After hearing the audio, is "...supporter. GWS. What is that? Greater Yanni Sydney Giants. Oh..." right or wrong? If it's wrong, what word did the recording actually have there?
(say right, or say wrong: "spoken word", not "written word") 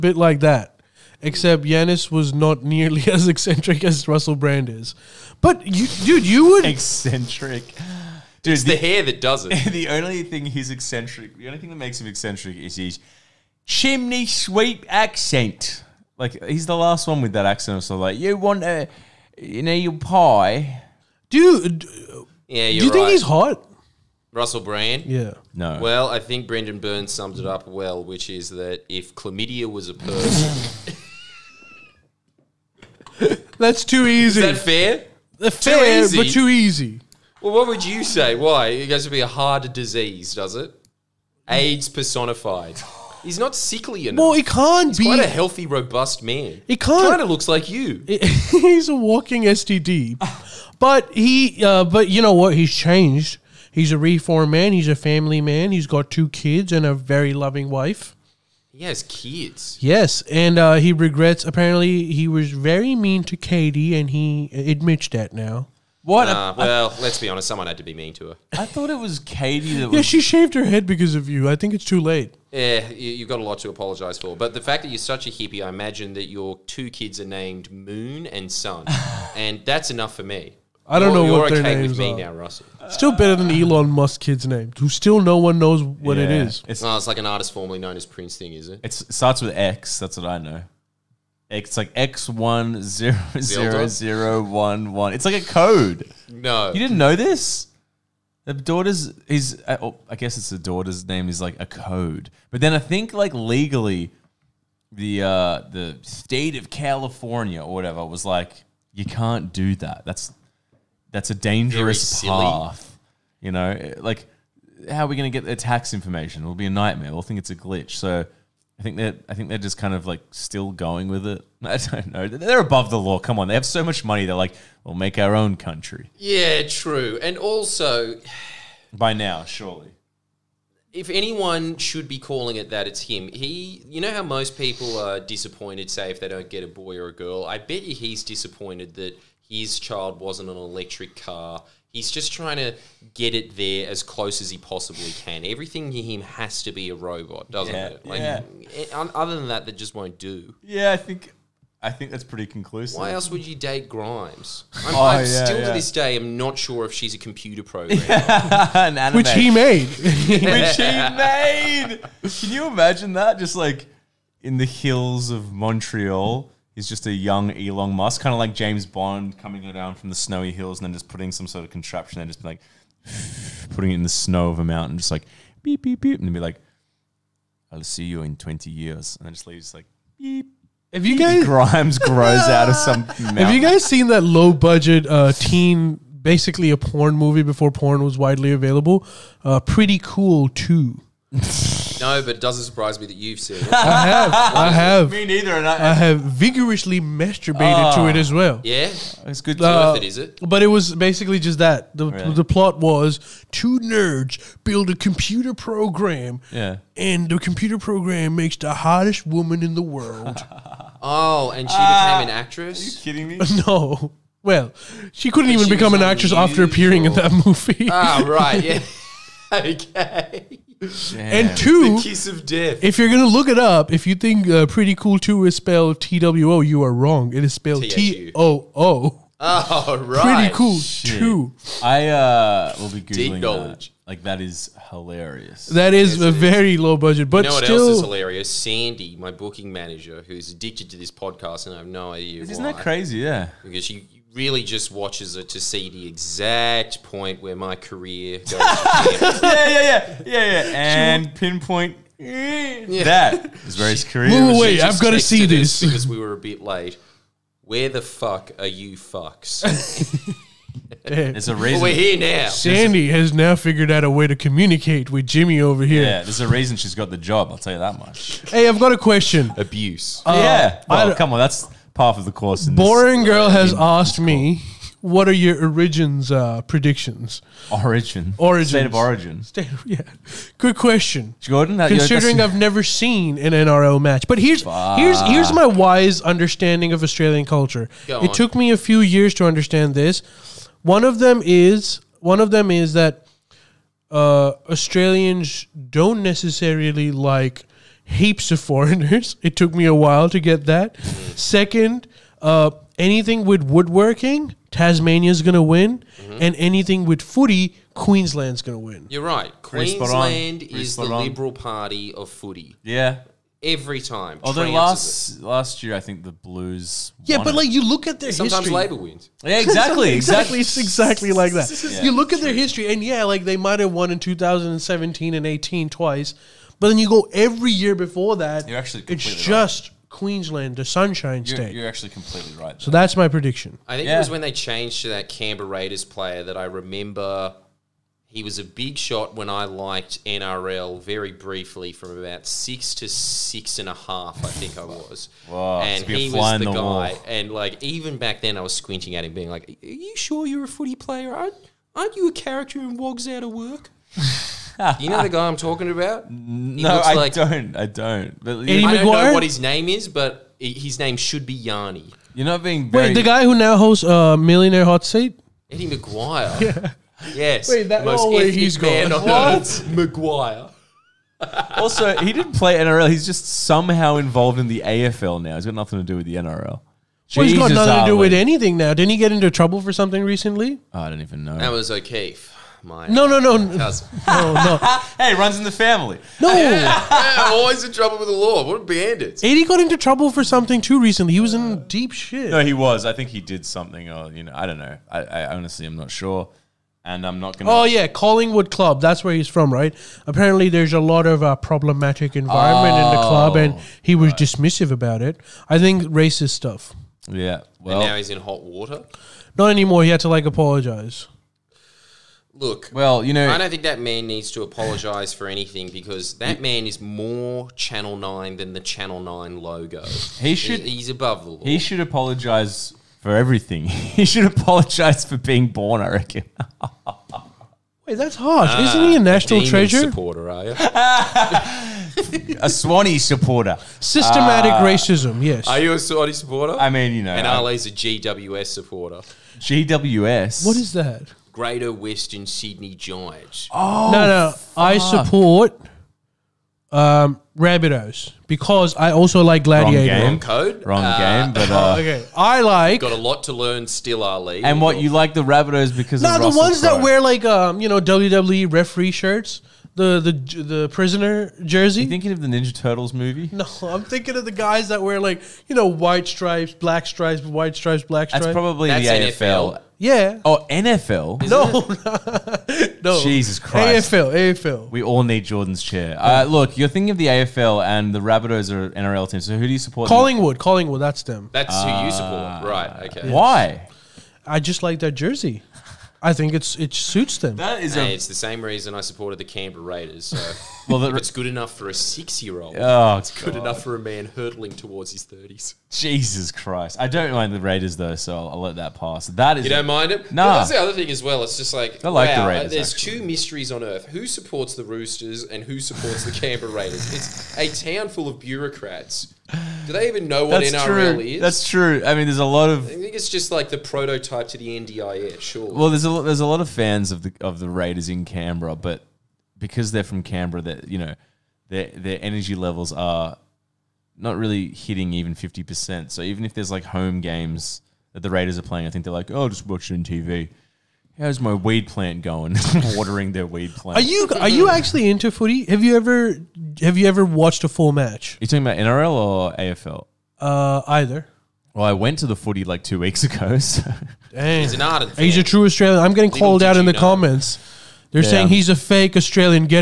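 wrong: "Western", not "Yanni".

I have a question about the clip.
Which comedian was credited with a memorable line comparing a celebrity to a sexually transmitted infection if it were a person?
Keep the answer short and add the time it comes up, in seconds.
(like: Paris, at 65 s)
Brendon Burns, at 26 s.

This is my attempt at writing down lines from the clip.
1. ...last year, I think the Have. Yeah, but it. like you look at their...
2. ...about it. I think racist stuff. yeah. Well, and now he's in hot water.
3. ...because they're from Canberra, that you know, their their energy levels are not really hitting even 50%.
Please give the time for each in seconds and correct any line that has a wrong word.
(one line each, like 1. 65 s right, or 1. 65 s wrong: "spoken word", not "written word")
1. 315 s wrong: "Blues", not "Have"
2. 404 s right
3. 519 s right.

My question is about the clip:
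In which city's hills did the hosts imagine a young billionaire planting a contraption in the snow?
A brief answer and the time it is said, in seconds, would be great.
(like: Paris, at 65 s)
Montreal, at 165 s.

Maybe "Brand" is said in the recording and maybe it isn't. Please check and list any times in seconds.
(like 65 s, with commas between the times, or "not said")
4 s, 24 s.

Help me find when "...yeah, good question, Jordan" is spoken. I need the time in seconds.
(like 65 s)
279 s.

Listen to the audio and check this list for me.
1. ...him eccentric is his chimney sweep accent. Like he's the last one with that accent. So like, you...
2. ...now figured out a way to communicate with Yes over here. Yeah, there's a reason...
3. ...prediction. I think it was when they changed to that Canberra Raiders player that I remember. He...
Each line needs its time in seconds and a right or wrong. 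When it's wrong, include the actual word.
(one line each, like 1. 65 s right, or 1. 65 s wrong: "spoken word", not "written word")
1. 12 s right
2. 263 s wrong: "Jimmy", not "Yes"
3. 333 s right.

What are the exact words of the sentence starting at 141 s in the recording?
He's just trying to get it there as close as he possibly can.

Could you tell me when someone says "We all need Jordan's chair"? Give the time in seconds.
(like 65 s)
474 s.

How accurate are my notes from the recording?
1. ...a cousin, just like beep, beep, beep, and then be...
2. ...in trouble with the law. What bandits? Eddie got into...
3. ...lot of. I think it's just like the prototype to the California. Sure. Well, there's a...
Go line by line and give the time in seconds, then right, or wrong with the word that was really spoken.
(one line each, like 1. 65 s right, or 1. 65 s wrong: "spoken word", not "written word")
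1. 174 s wrong: "mountain", not "cousin"
2. 387 s right
3. 512 s wrong: "NDIS", not "California".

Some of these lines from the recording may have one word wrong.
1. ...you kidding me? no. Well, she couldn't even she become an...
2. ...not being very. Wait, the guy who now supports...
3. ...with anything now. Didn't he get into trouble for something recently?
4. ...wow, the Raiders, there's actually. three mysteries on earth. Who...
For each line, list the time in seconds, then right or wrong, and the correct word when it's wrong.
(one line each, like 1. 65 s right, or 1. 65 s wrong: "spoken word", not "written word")
1. 212 s right
2. 362 s wrong: "hosts", not "supports"
3. 378 s right
4. 502 s wrong: "two", not "three".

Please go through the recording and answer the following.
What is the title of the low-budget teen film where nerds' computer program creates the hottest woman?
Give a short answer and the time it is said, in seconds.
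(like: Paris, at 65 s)
Pretty Cool Too, at 189 s.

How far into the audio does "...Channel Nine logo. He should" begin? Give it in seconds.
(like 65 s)
418 s.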